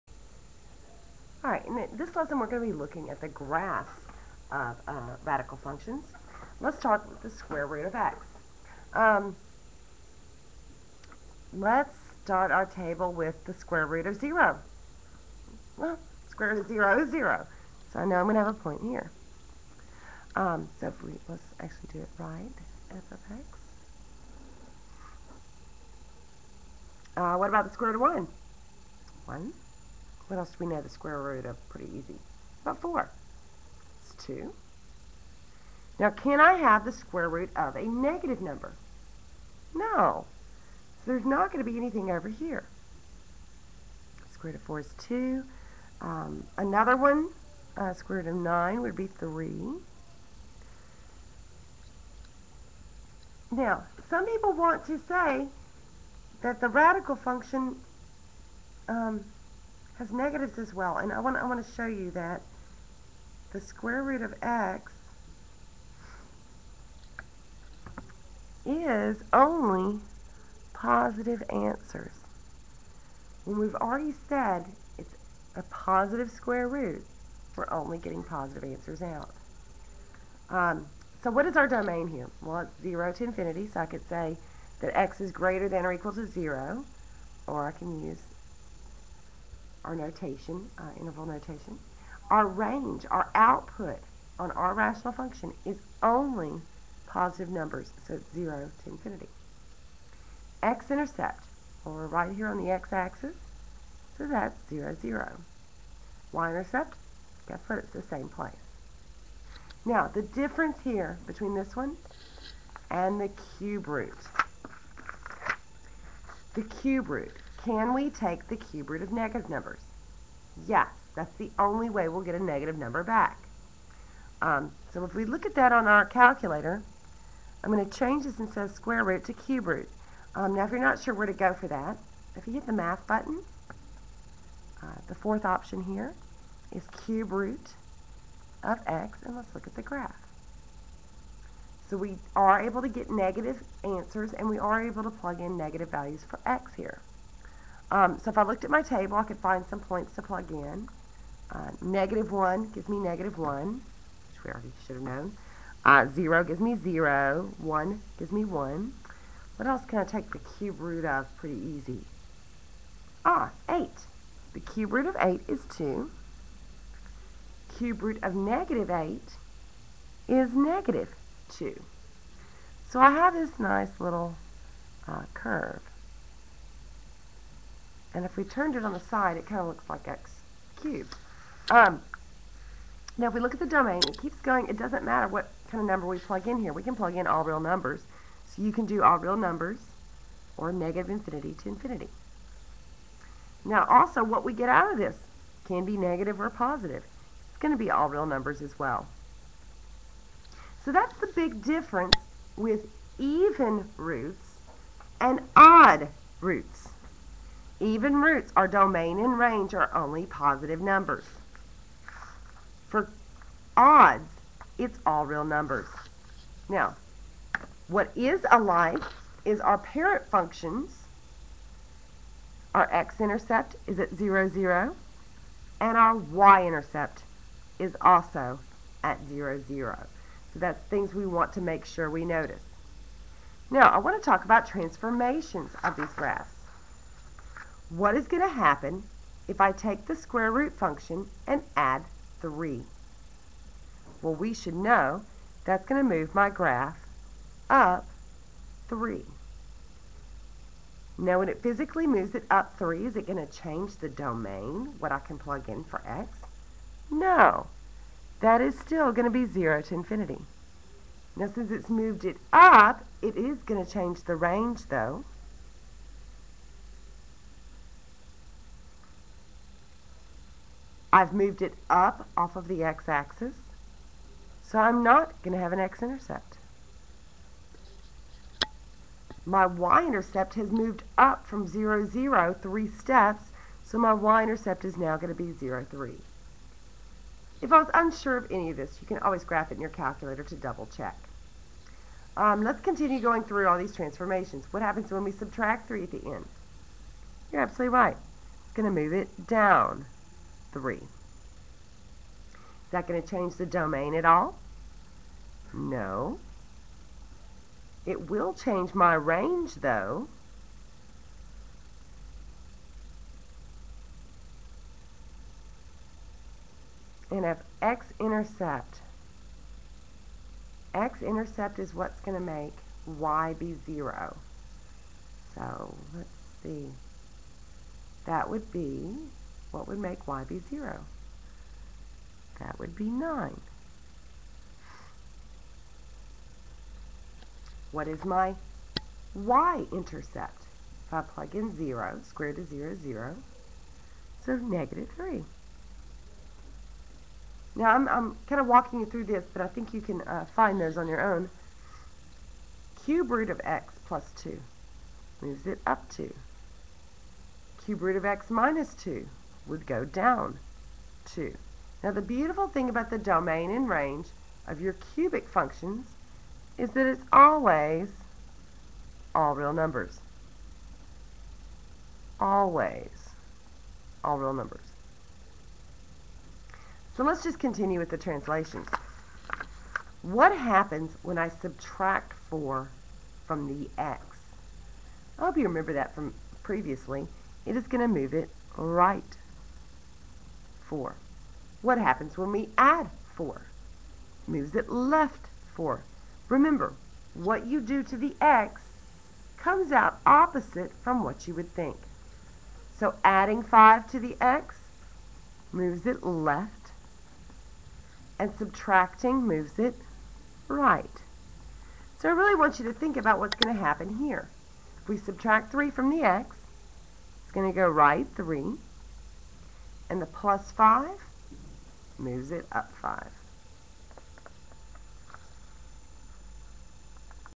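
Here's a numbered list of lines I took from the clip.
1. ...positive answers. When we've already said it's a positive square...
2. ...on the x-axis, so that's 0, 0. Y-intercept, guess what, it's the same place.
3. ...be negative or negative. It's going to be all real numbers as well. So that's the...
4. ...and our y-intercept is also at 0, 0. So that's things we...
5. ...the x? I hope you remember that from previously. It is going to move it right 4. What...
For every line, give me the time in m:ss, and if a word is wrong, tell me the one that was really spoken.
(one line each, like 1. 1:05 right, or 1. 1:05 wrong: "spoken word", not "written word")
1. 1:10 right
2. 1:42 right
3. 3:15 wrong: "positive", not "negative"
4. 3:45 right
5. 6:23 right.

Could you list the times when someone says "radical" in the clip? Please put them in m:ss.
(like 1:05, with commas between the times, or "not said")
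0:05, 0:56.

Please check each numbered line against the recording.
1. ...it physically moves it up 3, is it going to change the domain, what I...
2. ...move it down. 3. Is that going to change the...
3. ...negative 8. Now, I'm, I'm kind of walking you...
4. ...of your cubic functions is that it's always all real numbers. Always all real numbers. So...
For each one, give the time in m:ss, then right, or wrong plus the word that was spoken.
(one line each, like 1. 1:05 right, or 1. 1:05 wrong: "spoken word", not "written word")
1. 4:11 right
2. 4:59 right
3. 5:44 wrong: "3", not "8"
4. 6:04 right.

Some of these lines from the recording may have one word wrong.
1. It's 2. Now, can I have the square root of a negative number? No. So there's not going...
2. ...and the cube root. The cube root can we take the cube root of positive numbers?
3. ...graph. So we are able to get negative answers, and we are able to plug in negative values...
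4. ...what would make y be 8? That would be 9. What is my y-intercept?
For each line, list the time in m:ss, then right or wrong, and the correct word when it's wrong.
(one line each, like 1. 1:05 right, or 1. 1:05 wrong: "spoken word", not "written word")
1. 0:34 right
2. 1:52 wrong: "negative", not "positive"
3. 2:19 right
4. 5:29 wrong: "0", not "8".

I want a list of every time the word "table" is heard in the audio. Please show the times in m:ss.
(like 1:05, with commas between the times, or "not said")
0:12, 2:28.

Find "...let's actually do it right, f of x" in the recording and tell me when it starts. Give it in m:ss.
0:21.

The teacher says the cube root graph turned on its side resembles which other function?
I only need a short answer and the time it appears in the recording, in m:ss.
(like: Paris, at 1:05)
x cubed, at 3:00.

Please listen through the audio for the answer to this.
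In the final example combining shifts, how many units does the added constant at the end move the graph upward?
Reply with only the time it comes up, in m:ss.
7:02.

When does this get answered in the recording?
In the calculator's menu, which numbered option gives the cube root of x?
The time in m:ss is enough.
2:15.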